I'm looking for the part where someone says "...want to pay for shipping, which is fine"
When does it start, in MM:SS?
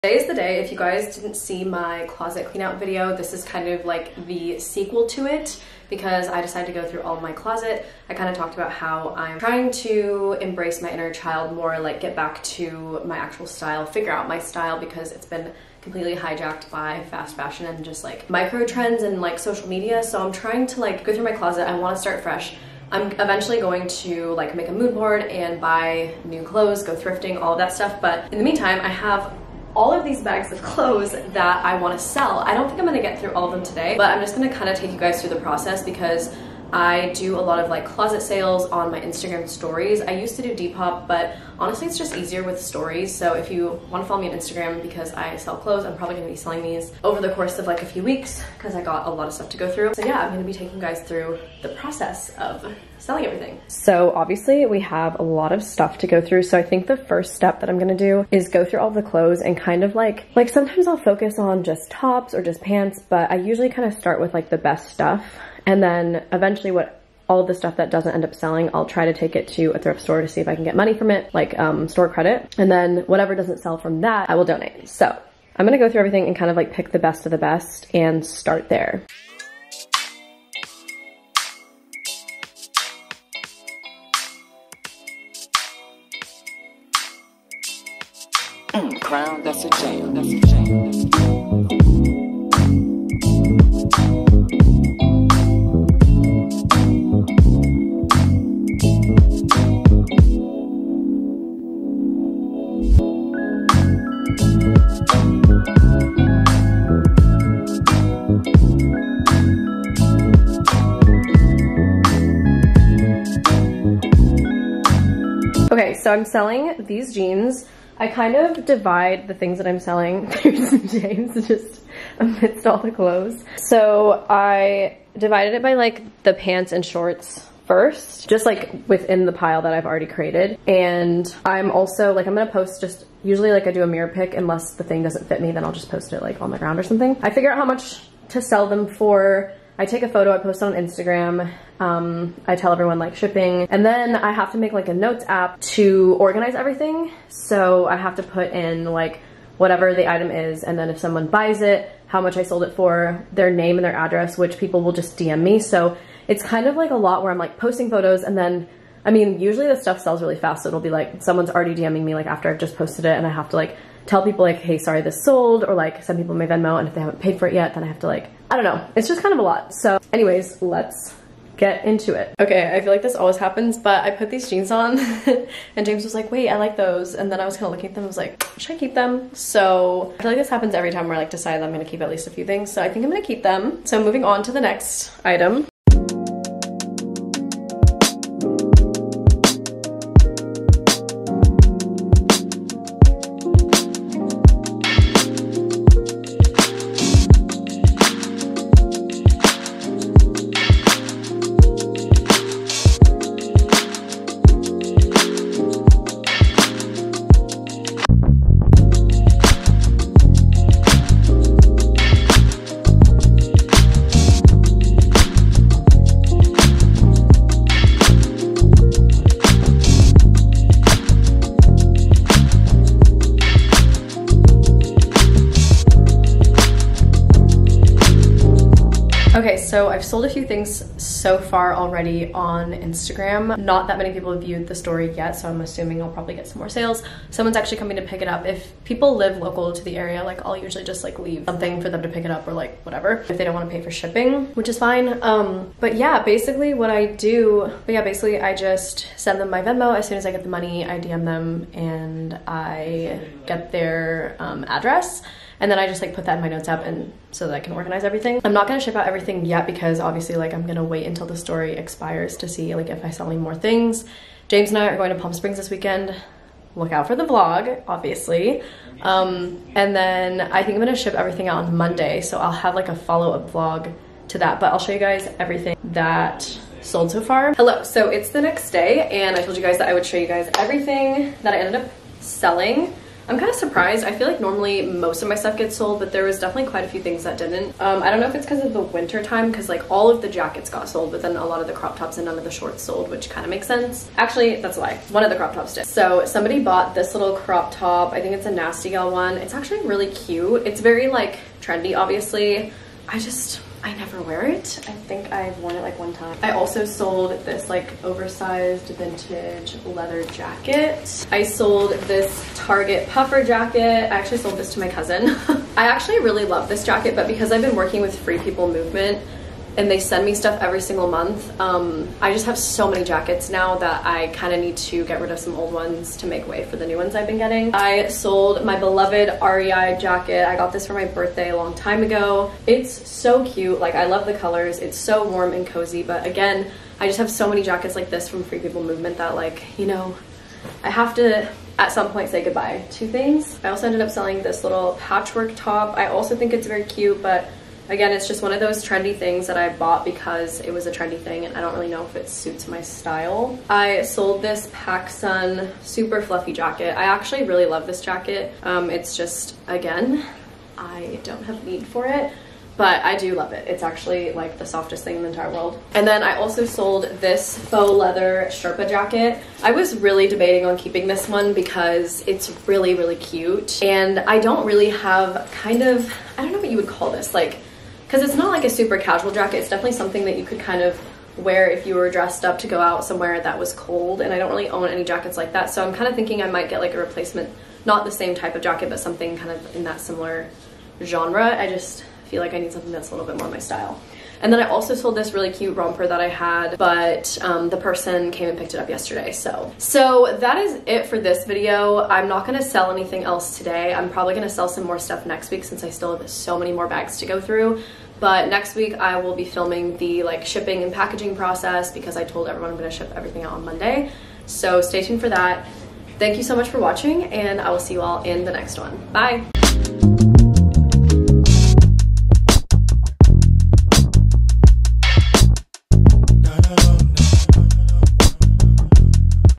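04:03.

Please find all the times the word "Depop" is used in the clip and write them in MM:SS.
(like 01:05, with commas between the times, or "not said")
00:40.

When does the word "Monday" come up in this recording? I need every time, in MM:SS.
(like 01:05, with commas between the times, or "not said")
04:31, 06:53.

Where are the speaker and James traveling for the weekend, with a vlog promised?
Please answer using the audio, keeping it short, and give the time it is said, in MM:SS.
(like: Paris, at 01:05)
Palm Springs, at 04:25.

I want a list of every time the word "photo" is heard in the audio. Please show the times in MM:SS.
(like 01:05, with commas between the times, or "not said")
02:20, 02:37.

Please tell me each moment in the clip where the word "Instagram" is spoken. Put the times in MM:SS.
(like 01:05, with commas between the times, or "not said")
00:39, 00:44, 02:20, 03:52.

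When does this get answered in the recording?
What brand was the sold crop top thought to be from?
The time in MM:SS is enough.
04:58.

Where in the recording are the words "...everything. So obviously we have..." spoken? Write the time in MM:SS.
00:53.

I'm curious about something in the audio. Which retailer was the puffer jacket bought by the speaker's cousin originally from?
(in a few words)
Target.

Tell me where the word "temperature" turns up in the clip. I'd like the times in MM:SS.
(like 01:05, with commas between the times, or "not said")
not said.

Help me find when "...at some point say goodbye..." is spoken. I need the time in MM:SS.
05:41.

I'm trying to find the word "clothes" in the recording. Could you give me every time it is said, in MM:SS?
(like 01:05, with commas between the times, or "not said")
00:26, 00:30, 00:45, 00:59, 02:02.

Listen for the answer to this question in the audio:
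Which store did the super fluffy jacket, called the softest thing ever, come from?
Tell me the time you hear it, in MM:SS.
05:54.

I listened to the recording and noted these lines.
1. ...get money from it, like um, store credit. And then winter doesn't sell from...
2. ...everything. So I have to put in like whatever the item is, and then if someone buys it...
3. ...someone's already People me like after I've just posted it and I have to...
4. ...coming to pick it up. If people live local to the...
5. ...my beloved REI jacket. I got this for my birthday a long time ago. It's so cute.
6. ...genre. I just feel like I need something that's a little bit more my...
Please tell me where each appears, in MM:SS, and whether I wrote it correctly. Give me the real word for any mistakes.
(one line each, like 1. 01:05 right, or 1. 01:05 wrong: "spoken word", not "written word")
1. 01:10 wrong: "whatever", not "winter"
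2. 02:26 right
3. 02:41 wrong: "DMing", not "People"
4. 03:57 right
5. 05:28 right
6. 06:31 right.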